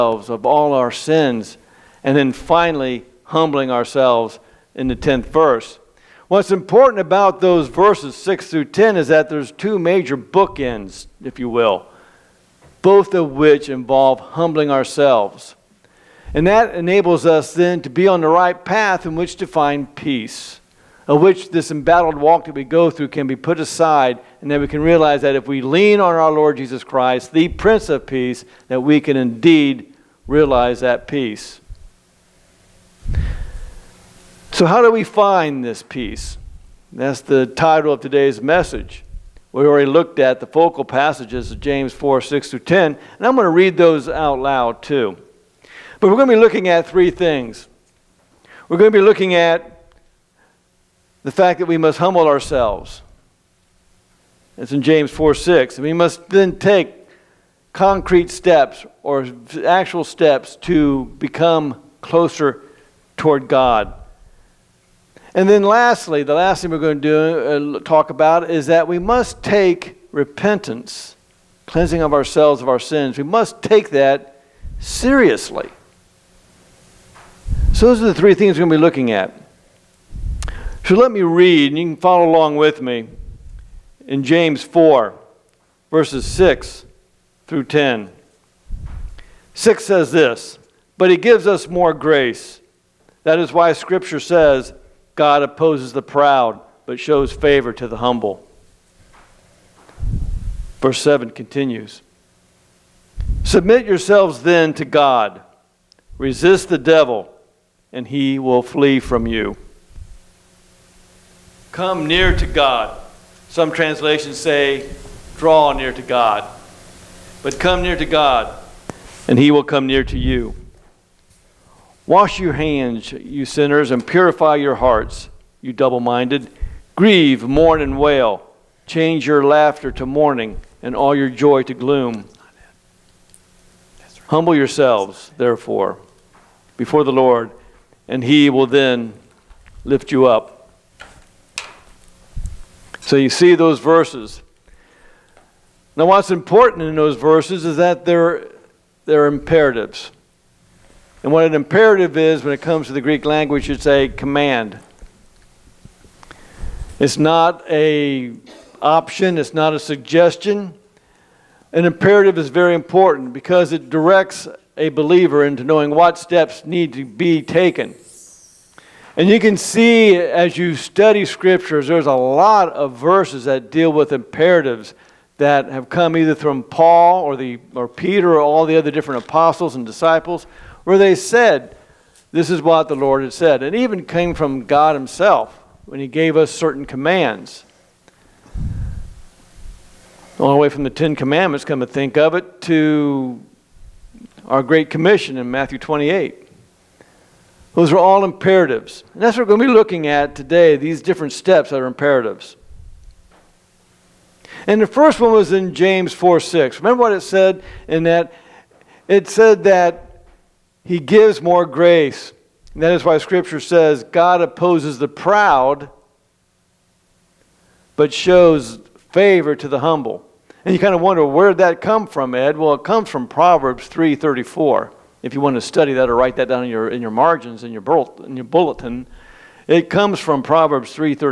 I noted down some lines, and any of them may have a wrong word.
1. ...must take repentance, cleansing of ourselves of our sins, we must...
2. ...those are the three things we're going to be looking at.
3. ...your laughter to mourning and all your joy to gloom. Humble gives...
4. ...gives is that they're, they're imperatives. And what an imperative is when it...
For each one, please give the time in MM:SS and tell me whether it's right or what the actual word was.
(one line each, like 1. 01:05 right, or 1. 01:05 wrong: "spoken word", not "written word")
1. 01:08 right
2. 01:17 right
3. 02:09 wrong: "yourselves", not "gives"
4. 02:27 wrong: "verses", not "gives".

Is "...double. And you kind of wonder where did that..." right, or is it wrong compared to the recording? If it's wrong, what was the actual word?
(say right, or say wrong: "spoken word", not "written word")
wrong: "humble", not "double".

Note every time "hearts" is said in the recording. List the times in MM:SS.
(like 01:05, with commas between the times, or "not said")
02:04.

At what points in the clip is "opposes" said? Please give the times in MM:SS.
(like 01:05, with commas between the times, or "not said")
01:35, 03:34.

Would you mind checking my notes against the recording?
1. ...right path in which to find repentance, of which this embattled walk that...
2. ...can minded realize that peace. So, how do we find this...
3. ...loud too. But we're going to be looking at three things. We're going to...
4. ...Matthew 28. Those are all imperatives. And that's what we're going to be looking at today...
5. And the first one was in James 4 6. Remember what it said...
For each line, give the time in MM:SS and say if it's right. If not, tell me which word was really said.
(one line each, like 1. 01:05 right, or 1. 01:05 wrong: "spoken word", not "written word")
1. 00:18 wrong: "peace", not "repentance"
2. 00:28 wrong: "indeed", not "minded"
3. 00:44 right
4. 03:15 right
5. 03:24 right.